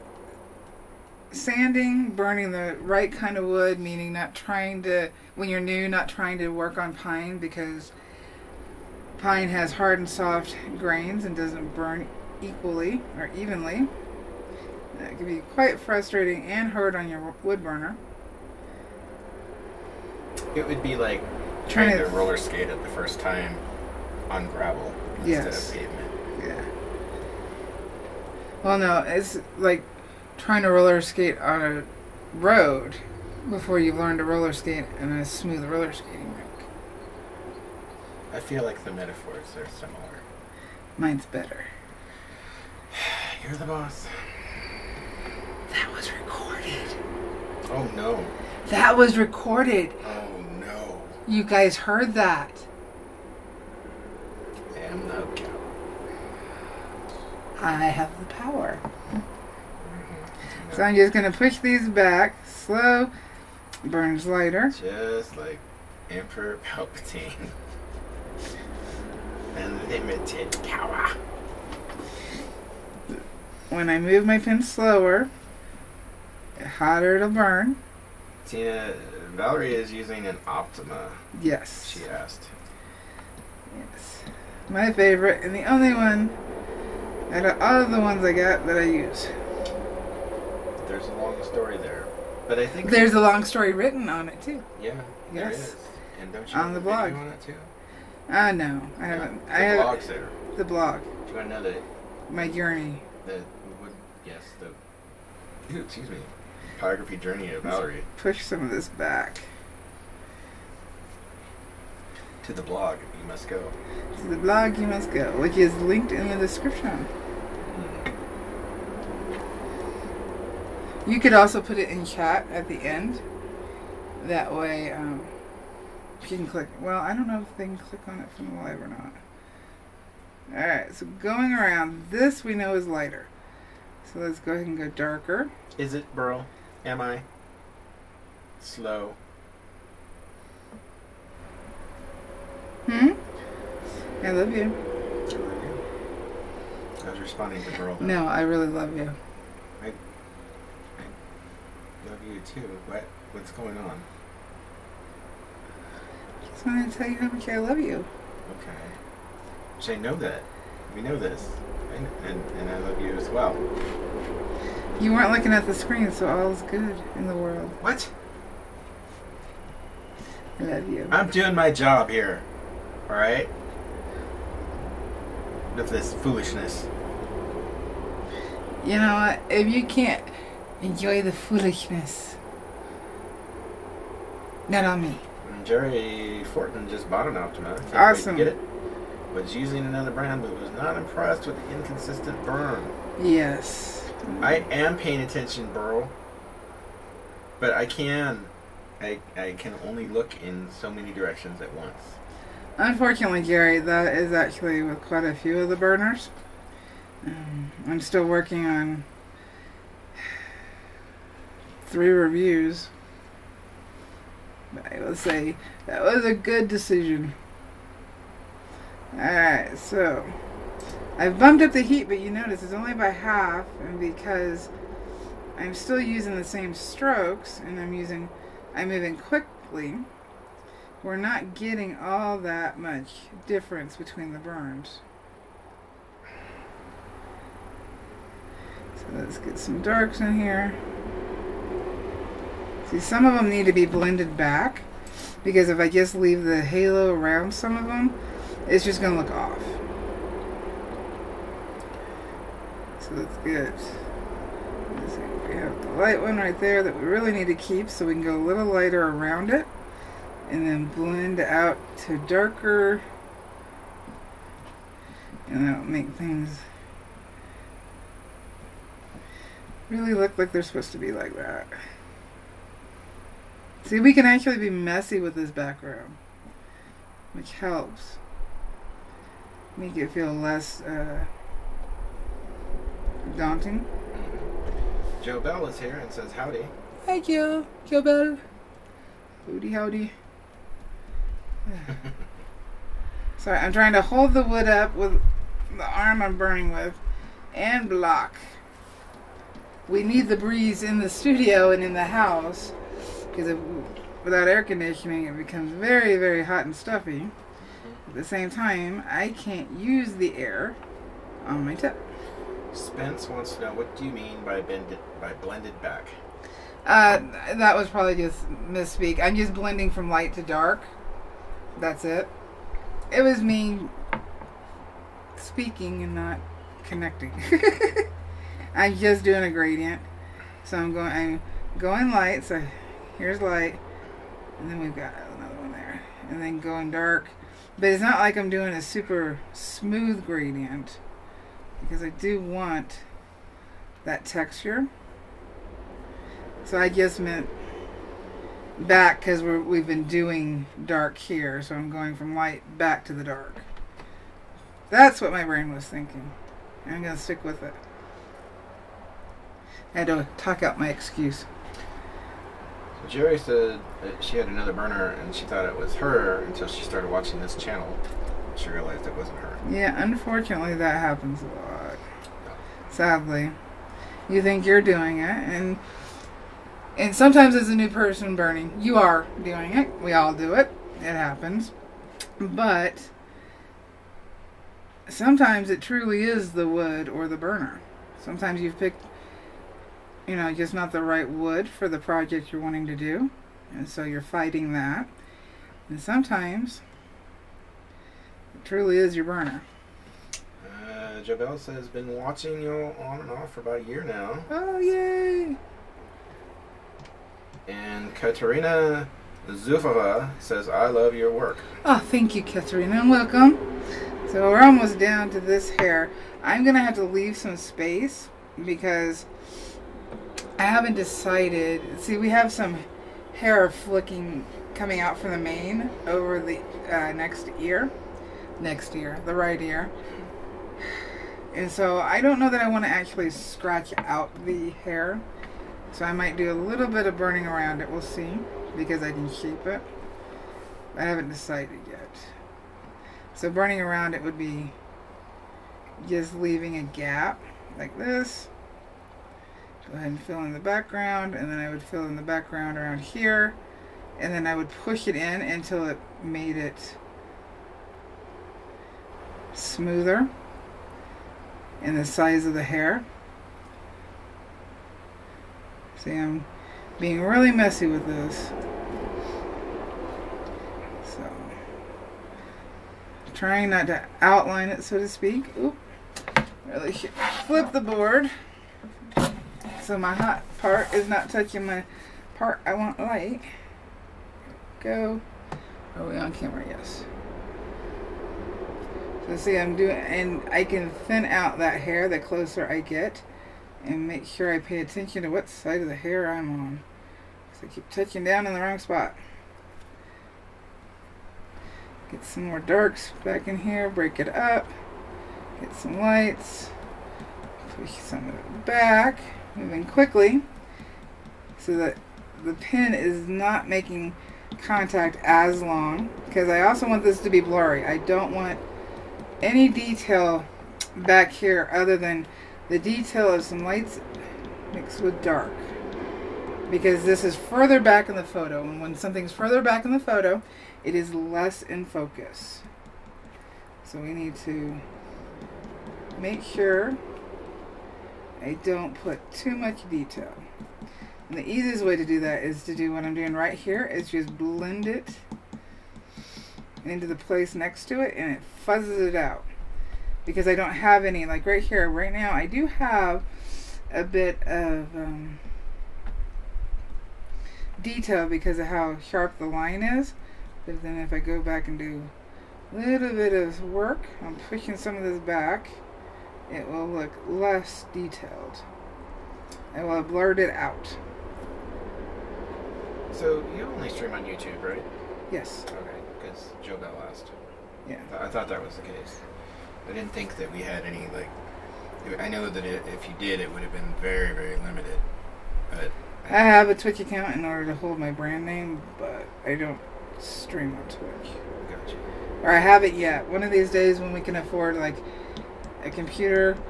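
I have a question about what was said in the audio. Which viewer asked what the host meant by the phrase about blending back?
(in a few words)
Spence.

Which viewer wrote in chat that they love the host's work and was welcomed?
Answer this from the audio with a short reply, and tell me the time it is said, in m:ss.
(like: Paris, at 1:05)
Katerina Zufova, at 6:48.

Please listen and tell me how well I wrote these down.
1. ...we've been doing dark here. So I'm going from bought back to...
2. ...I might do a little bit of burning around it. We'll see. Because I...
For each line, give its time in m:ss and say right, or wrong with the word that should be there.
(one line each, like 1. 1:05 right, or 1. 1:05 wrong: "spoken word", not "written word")
1. 5:49 wrong: "light", not "bought"
2. 7:16 right.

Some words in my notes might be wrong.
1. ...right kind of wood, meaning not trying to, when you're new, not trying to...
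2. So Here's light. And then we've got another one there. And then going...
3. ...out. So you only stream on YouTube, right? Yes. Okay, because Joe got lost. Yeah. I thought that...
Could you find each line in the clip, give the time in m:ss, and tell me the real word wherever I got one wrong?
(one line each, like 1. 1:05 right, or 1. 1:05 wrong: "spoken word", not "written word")
1. 0:02 right
2. 5:32 right
3. 9:30 right.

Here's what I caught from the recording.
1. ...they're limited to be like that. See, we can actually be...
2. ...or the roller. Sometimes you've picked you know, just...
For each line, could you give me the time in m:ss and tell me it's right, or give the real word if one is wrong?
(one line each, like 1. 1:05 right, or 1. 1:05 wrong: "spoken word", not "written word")
1. 4:30 wrong: "supposed", not "limited"
2. 6:27 wrong: "burner", not "roller".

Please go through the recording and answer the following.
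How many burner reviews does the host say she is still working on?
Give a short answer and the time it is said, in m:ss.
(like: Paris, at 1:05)
3, at 3:31.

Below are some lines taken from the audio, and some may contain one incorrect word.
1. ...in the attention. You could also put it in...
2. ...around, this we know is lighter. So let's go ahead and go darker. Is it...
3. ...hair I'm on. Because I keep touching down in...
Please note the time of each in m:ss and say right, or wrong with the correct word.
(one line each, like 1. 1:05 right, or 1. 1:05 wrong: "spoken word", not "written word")
1. 1:56 wrong: "description", not "attention"
2. 2:11 right
3. 8:15 right.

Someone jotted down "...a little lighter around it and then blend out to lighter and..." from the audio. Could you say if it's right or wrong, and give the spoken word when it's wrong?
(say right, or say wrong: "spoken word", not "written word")
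wrong: "darker", not "lighter".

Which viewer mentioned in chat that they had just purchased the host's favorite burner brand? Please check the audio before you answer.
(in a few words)
Jerry Fortin.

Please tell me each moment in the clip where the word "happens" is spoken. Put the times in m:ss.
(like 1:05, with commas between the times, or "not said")
6:10, 6:21.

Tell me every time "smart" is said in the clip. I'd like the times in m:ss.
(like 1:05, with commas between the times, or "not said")
not said.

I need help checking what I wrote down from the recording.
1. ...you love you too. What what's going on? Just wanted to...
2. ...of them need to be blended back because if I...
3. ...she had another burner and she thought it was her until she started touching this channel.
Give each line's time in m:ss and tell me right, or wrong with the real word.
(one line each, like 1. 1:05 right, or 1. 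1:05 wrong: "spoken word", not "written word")
1. 2:28 right
2. 4:03 right
3. 6:04 wrong: "watching", not "touching".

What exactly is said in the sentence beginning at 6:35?
And sometimes it truly is your burner.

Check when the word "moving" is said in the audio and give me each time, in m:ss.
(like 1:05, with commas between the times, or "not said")
3:48, 8:29.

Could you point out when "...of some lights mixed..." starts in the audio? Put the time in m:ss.
8:43.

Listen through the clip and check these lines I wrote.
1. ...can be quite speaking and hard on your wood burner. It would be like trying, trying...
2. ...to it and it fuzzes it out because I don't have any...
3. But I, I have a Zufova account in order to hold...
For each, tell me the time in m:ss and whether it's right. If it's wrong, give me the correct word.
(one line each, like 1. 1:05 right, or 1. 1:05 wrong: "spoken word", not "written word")
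1. 0:15 wrong: "frustrating", not "speaking"
2. 9:07 right
3. 9:45 wrong: "Twitch", not "Zufova".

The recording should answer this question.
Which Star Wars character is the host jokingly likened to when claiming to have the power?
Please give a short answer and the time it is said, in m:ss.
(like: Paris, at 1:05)
Emperor Palpatine, at 1:06.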